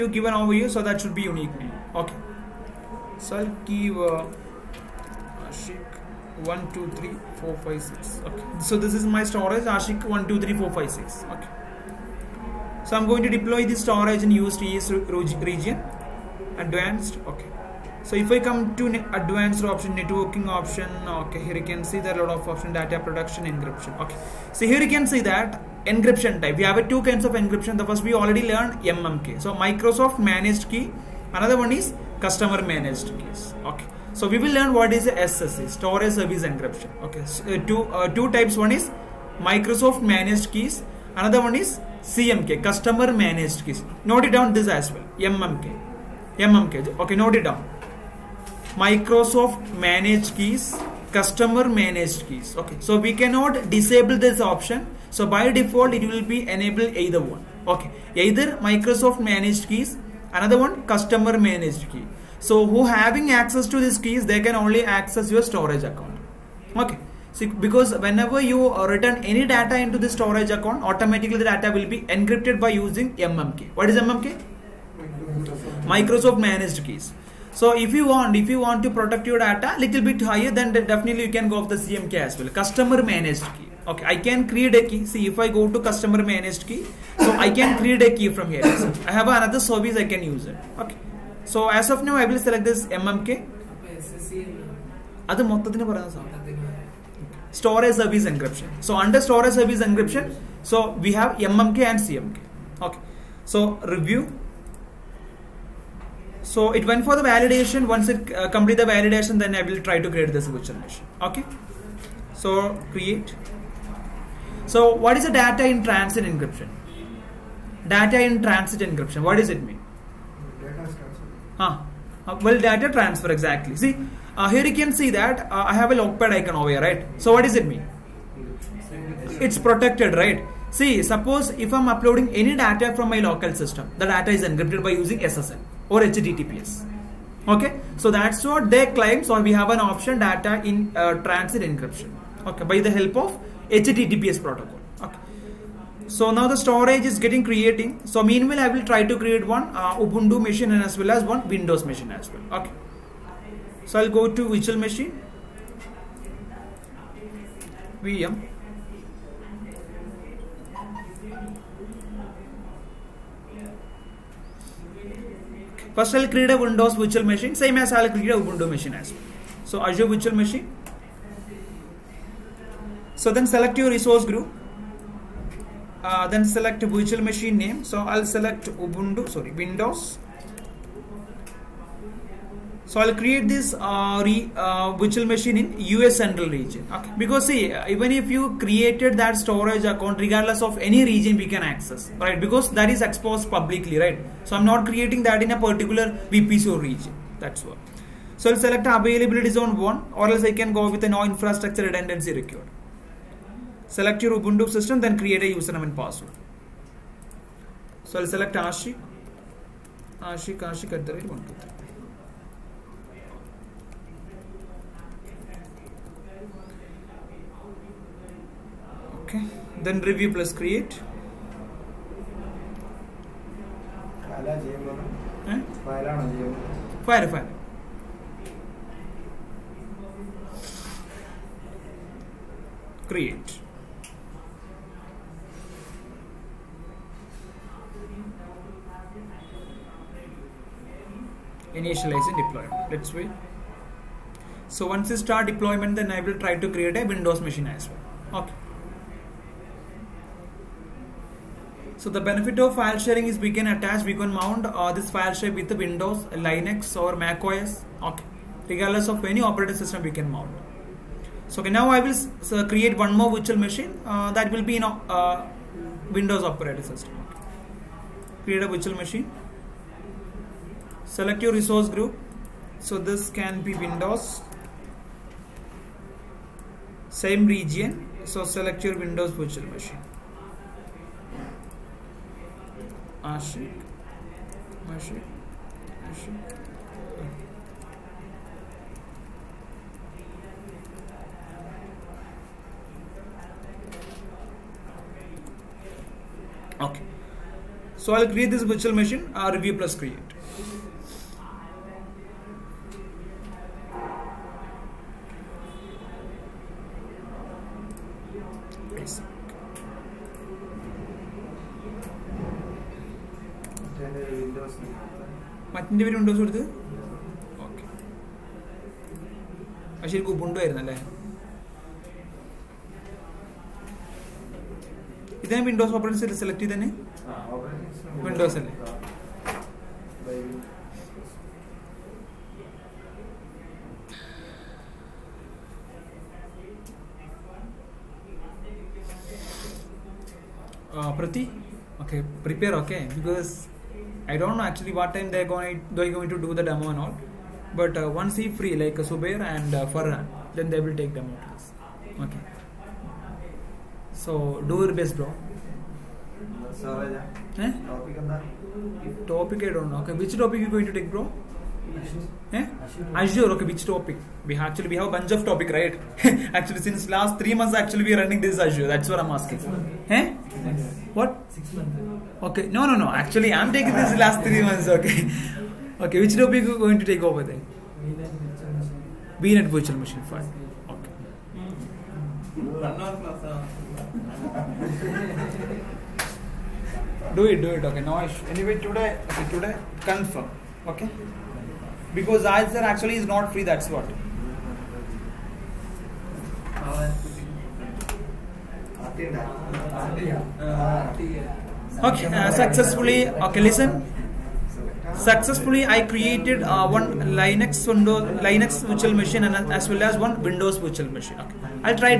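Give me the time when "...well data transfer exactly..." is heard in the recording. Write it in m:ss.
2:02.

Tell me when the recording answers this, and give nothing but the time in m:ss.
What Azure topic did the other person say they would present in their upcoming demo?
6:19.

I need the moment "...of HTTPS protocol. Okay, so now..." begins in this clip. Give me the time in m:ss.
2:23.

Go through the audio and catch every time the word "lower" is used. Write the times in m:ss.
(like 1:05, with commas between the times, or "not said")
not said.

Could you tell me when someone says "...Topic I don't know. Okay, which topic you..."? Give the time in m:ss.
5:59.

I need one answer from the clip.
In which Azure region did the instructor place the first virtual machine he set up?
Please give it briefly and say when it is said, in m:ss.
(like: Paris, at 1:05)
US central, at 3:05.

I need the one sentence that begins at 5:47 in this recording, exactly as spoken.
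But uh, once he free like uh, Subair and uh, Farhan, then they will take them out.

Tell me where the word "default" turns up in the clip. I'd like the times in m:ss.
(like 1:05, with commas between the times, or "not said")
0:55.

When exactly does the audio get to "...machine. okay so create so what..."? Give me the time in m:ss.
1:50.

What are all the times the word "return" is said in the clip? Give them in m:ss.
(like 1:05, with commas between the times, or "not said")
1:08.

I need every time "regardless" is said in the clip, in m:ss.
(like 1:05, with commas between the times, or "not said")
3:10, 4:18.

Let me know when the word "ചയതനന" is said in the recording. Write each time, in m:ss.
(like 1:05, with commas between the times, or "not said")
5:26.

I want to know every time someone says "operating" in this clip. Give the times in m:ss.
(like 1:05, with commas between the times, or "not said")
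4:19, 4:26.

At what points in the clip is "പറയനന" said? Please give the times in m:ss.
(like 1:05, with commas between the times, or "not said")
1:35.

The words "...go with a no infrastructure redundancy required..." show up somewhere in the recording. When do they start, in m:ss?
3:20.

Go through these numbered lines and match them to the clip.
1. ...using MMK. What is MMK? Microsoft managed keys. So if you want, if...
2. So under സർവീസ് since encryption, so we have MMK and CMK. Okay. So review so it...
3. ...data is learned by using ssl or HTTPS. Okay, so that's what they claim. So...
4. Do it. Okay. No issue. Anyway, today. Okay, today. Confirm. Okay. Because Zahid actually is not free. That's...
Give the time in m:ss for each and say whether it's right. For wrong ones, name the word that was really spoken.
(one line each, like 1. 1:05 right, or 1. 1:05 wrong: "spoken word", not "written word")
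1. 1:12 right
2. 1:38 wrong: "service", not "since"
3. 2:14 wrong: "encrypted", not "learned"
4. 6:27 right.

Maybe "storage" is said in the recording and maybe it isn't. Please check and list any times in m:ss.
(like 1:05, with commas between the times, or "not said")
0:09, 0:13, 0:35, 1:05, 1:10, 1:37, 2:26, 3:09.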